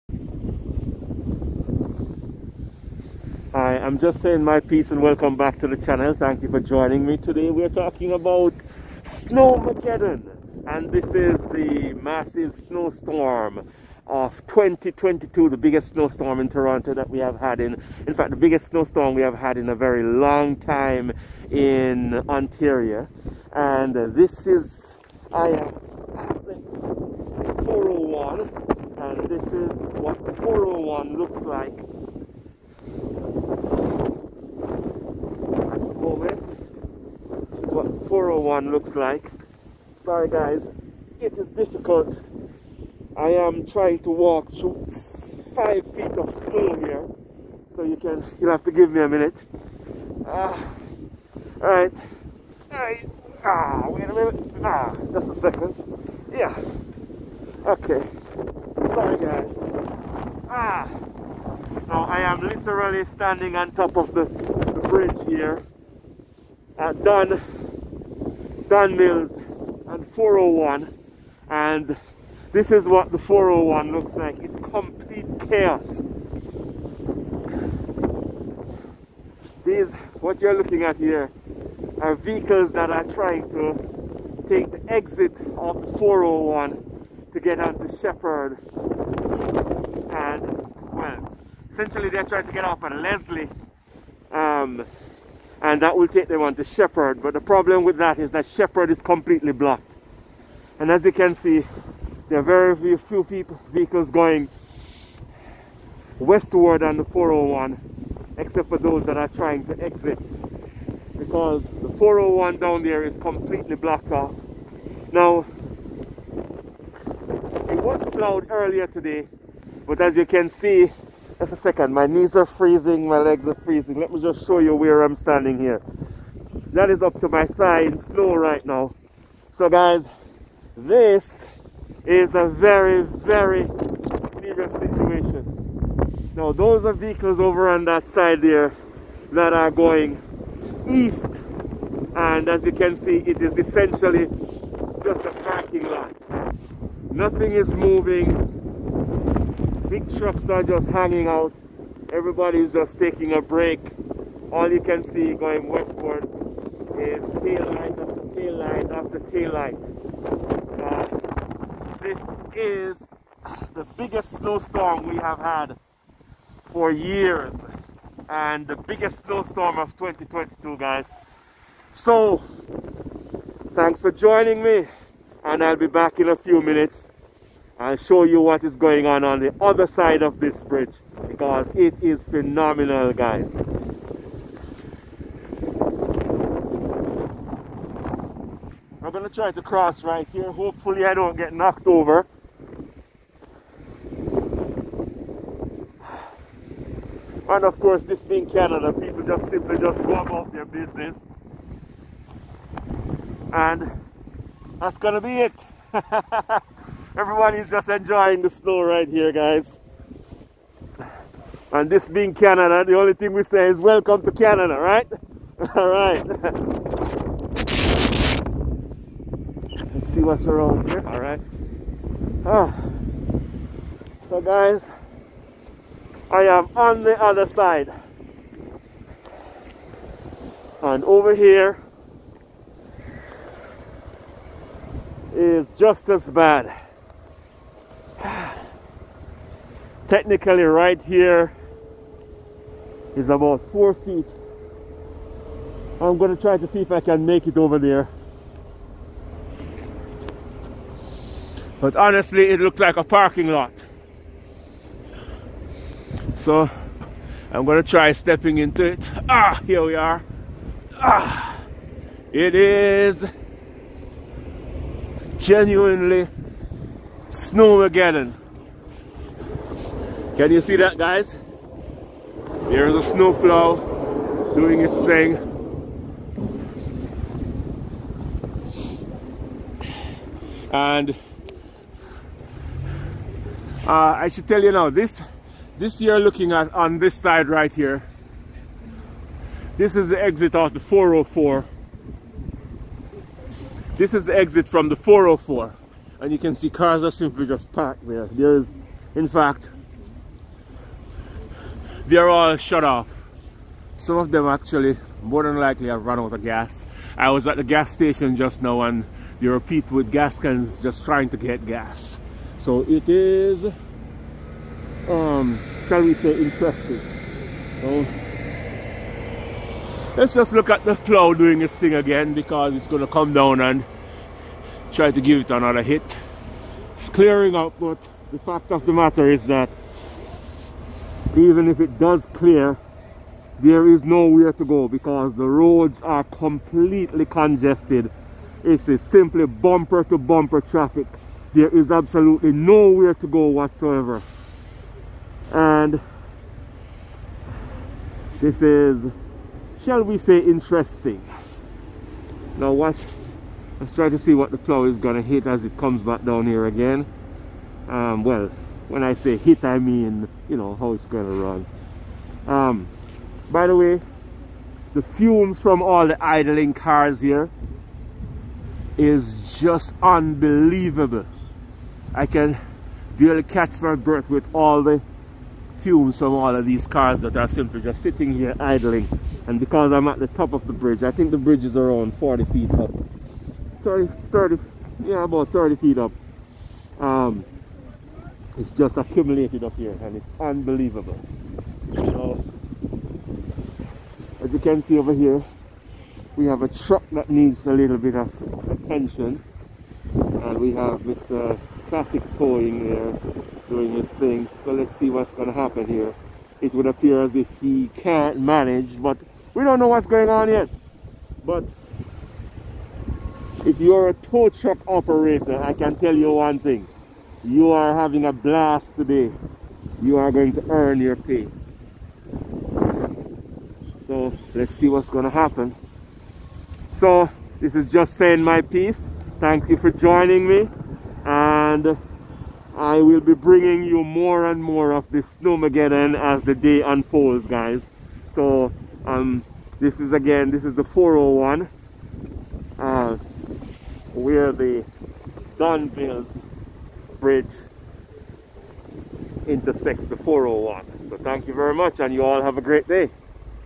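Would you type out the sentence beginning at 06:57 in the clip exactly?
You are having a blast today.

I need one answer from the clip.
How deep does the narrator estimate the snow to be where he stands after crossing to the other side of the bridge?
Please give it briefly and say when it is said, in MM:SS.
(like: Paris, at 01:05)
about four feet, at 04:03.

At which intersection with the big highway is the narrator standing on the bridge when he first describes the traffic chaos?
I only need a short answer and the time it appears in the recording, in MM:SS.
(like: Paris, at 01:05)
Don Mills, at 01:06.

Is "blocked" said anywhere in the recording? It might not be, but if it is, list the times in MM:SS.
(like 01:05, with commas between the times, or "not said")
01:39, 01:53.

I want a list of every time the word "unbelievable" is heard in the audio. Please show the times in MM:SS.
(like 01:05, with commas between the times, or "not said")
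06:10, 06:30.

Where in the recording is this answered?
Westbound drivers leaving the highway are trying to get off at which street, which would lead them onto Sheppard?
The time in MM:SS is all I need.
01:33.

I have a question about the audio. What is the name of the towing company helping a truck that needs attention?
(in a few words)
Classic Towing.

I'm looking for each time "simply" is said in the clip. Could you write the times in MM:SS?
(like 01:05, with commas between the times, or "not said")
03:19, 04:57, 05:39, 06:17.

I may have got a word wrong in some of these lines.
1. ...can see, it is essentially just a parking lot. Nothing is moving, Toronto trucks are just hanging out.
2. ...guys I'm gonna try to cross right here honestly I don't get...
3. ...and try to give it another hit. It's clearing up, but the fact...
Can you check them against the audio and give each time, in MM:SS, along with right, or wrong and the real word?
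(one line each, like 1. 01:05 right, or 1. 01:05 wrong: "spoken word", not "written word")
1. 02:22 wrong: "Big", not "Toronto"
2. 03:03 wrong: "hopefully", not "honestly"
3. 05:23 right.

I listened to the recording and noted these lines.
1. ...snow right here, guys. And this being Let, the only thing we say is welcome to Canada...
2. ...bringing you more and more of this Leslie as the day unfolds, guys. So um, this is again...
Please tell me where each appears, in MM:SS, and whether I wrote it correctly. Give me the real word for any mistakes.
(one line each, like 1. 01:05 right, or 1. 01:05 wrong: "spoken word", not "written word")
1. 03:28 wrong: "Canada", not "Let"
2. 07:13 wrong: "Snowmageddon", not "Leslie".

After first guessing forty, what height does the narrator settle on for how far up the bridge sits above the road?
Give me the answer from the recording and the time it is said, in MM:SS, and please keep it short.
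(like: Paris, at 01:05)
30 feet, at 06:25.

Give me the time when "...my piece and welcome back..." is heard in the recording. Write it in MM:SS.
00:04.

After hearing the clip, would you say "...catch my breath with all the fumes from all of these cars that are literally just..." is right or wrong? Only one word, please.
wrong.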